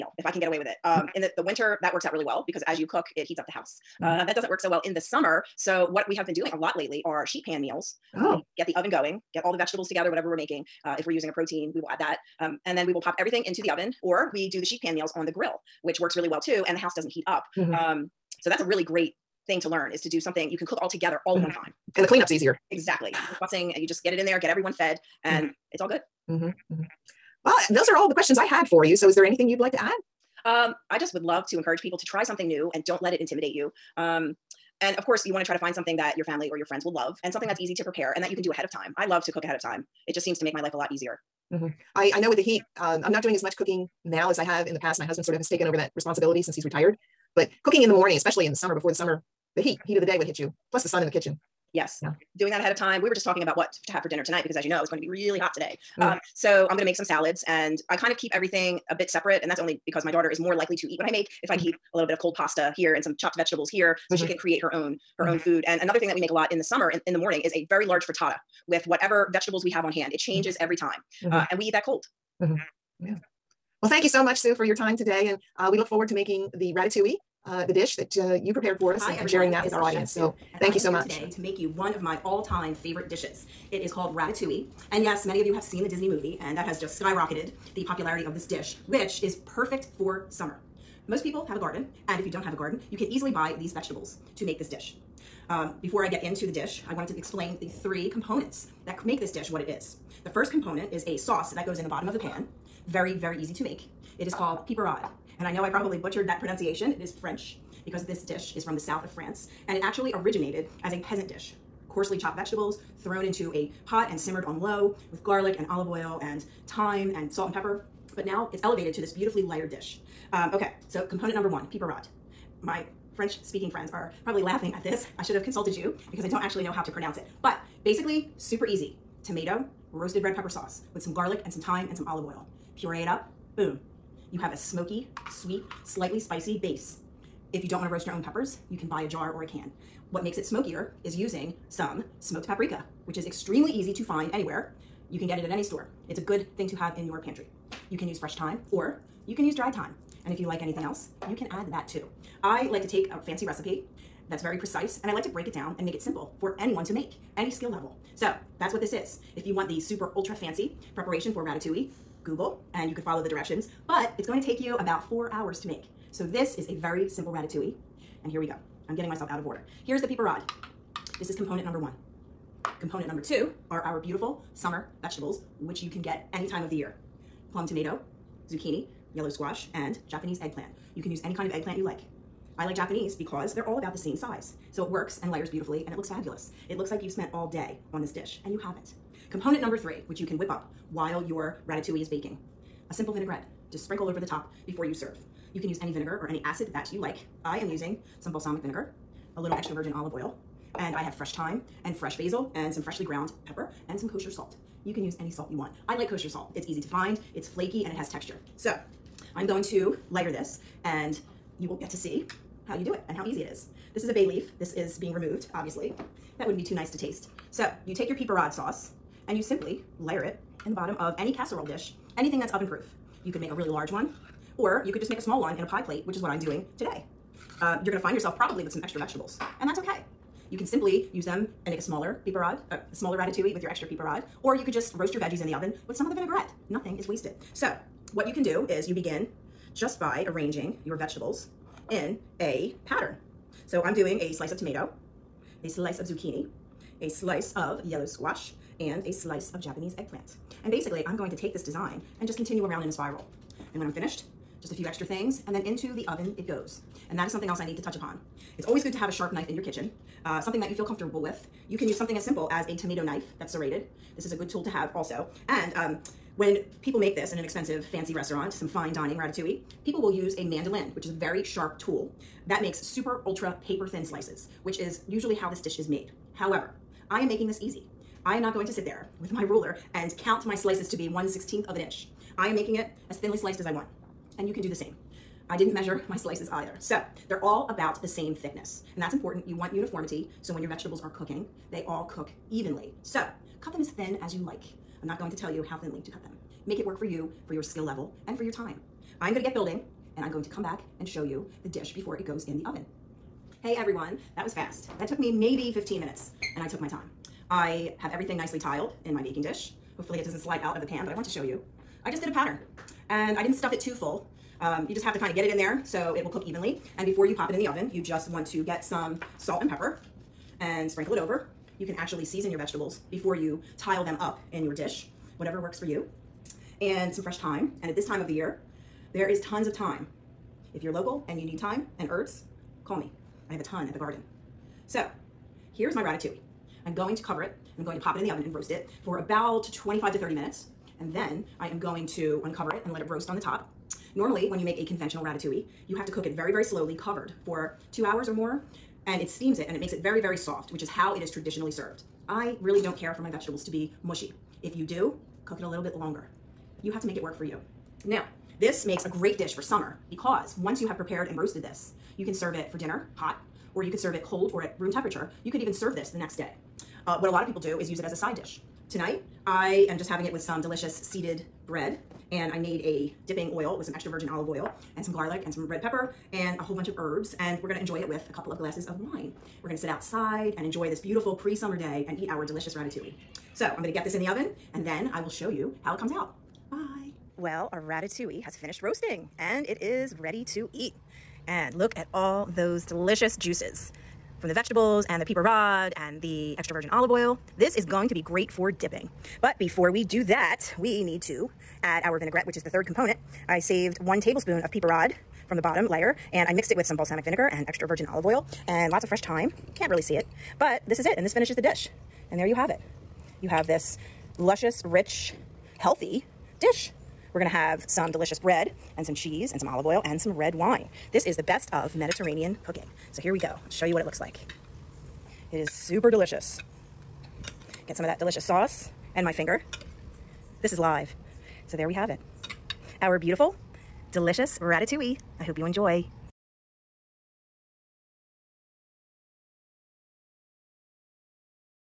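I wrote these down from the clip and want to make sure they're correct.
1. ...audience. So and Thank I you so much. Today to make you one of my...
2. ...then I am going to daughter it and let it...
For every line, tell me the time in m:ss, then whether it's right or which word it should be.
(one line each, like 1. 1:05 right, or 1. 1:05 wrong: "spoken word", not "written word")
1. 1:19 right
2. 5:41 wrong: "uncover", not "daughter".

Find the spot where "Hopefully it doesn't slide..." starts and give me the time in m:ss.
5:09.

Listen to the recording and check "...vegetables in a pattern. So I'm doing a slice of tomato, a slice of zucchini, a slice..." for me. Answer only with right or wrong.
right.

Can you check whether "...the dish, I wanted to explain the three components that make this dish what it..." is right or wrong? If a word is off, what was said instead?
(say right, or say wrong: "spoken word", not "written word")
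right.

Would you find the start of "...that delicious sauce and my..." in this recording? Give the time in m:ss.
7:08.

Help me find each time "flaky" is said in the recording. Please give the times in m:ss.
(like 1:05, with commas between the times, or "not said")
3:27.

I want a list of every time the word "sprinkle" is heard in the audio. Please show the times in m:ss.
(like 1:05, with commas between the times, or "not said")
3:13, 5:20.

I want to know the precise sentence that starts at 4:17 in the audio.
And that is something else I need to touch upon.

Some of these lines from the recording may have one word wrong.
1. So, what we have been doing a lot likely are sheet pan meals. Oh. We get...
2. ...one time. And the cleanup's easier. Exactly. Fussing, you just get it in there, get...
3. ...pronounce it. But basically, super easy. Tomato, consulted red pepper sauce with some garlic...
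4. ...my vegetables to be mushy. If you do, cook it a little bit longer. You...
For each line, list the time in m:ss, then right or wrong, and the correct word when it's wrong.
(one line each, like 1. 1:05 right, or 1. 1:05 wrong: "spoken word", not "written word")
1. 0:05 wrong: "lately", not "likely"
2. 0:21 right
3. 2:06 wrong: "roasted", not "consulted"
4. 5:53 right.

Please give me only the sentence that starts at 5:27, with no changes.
And at this time of the year, there is tons of thyme.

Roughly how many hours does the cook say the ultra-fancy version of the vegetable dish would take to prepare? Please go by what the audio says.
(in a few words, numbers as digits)
4.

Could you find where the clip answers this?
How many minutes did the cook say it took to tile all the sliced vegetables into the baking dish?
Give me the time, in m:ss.
5:05.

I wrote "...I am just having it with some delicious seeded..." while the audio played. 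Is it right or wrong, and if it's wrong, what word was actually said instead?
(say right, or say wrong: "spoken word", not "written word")
right.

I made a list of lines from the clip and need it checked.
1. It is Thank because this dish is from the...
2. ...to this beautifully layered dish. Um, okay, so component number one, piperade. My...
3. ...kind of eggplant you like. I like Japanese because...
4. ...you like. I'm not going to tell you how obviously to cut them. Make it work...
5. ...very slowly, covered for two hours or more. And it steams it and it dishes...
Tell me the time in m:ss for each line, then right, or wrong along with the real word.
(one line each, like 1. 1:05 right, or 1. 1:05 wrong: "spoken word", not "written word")
1. 1:46 wrong: "French", not "Thank"
2. 1:58 right
3. 3:01 right
4. 4:54 wrong: "thinly", not "obviously"
5. 5:46 wrong: "makes", not "dishes".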